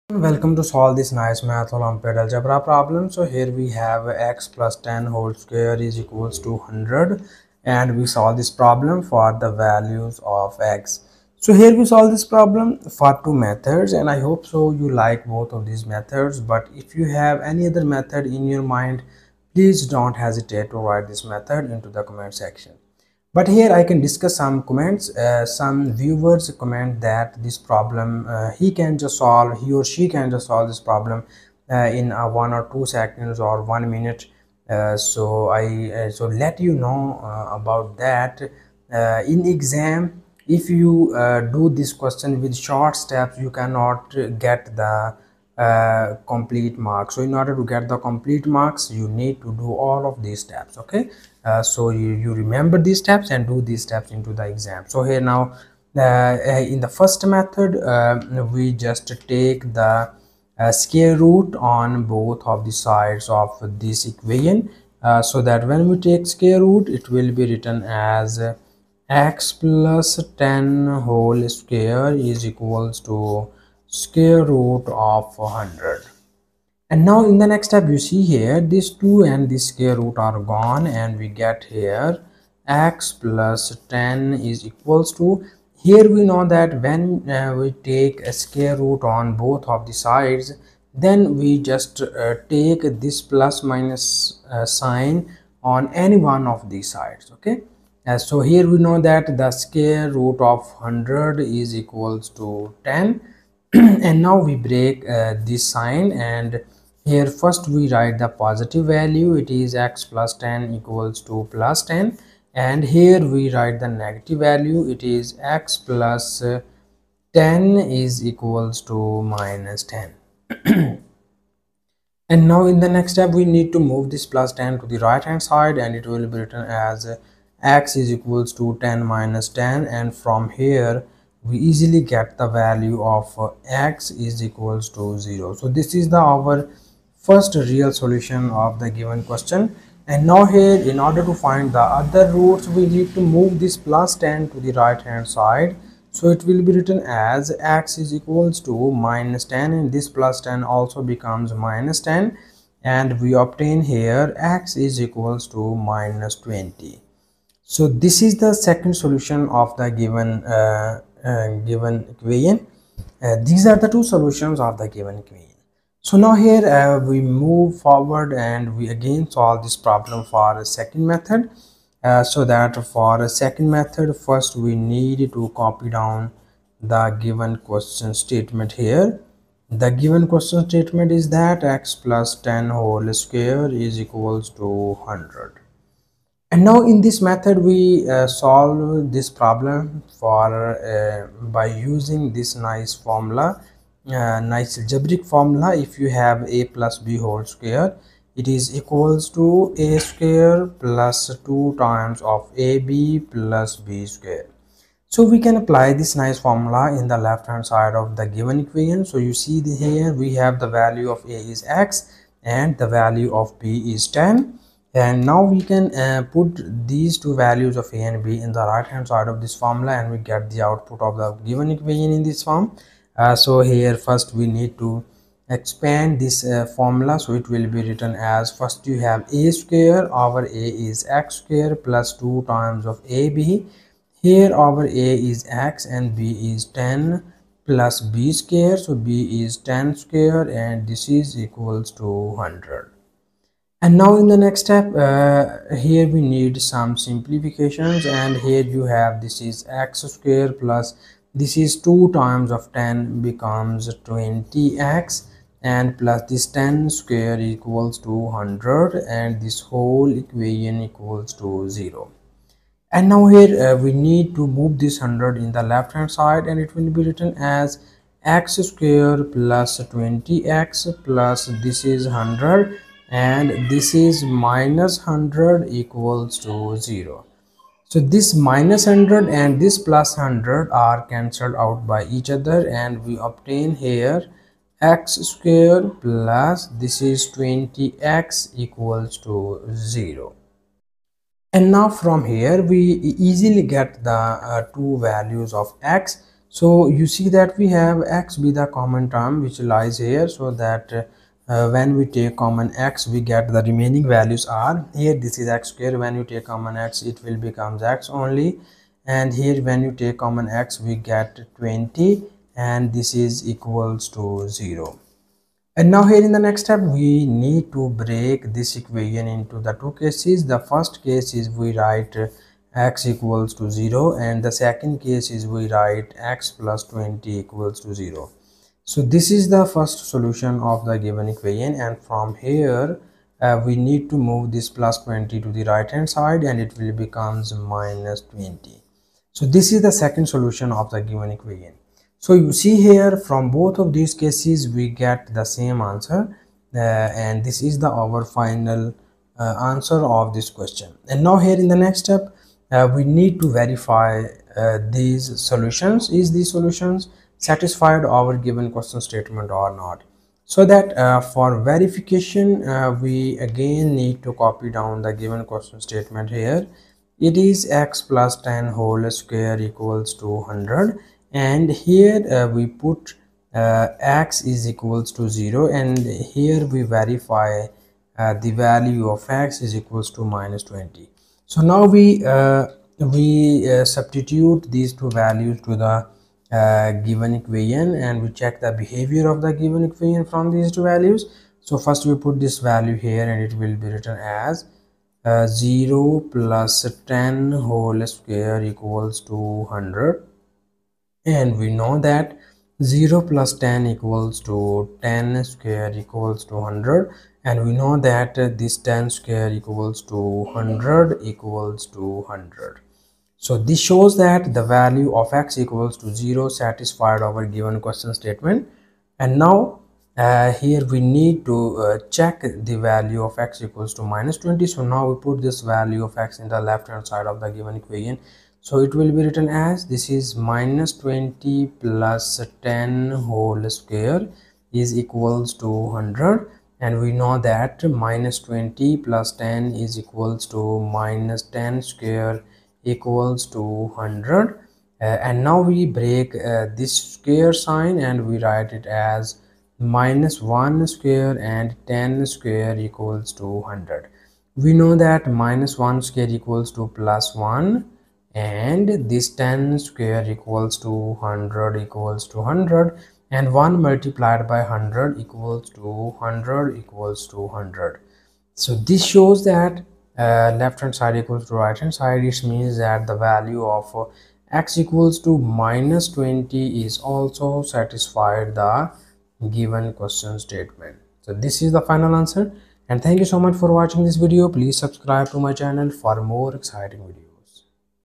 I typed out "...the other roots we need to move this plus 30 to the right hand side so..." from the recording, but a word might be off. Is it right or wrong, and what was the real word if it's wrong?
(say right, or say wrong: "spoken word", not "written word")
wrong: "10", not "30".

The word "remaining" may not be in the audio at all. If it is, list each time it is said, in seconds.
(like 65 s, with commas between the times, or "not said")
303 s.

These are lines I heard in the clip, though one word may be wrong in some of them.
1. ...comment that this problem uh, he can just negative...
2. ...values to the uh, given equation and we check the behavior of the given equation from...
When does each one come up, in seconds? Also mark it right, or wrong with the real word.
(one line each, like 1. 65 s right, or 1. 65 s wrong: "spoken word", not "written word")
1. 26 s wrong: "solve", not "negative"
2. 385 s right.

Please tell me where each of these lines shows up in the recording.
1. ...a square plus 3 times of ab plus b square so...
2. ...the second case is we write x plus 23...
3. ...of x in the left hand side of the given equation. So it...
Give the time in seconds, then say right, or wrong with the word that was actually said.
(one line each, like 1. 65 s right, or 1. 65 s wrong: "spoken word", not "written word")
1. 199 s wrong: "2", not "3"
2. 324 s wrong: "20", not "23"
3. 426 s right.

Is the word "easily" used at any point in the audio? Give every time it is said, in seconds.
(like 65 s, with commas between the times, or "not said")
131 s, 293 s.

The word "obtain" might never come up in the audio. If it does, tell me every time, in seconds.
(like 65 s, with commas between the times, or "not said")
153 s, 283 s.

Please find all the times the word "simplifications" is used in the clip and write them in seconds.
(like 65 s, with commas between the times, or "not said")
246 s.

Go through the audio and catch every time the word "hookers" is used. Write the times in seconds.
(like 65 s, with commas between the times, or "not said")
not said.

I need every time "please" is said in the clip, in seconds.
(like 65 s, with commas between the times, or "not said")
19 s, 484 s.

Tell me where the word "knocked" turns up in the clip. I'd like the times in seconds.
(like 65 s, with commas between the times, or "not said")
not said.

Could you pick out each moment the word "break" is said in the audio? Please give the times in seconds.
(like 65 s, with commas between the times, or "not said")
104 s, 317 s, 445 s.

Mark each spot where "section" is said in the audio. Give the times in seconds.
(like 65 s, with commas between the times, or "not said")
22 s.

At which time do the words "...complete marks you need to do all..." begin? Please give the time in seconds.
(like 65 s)
47 s.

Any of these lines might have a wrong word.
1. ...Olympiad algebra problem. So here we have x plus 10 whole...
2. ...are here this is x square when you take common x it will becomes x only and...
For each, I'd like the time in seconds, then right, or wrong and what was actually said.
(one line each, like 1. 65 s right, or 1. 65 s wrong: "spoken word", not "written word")
1. 1 s right
2. 304 s right.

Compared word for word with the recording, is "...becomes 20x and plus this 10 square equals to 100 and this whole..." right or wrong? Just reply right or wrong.
right.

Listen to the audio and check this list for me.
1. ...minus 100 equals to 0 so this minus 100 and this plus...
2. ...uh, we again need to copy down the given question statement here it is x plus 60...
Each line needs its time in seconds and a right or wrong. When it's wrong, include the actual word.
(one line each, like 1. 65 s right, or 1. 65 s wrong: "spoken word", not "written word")
1. 274 s right
2. 362 s wrong: "10", not "60".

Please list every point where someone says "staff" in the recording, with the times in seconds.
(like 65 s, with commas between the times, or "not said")
not said.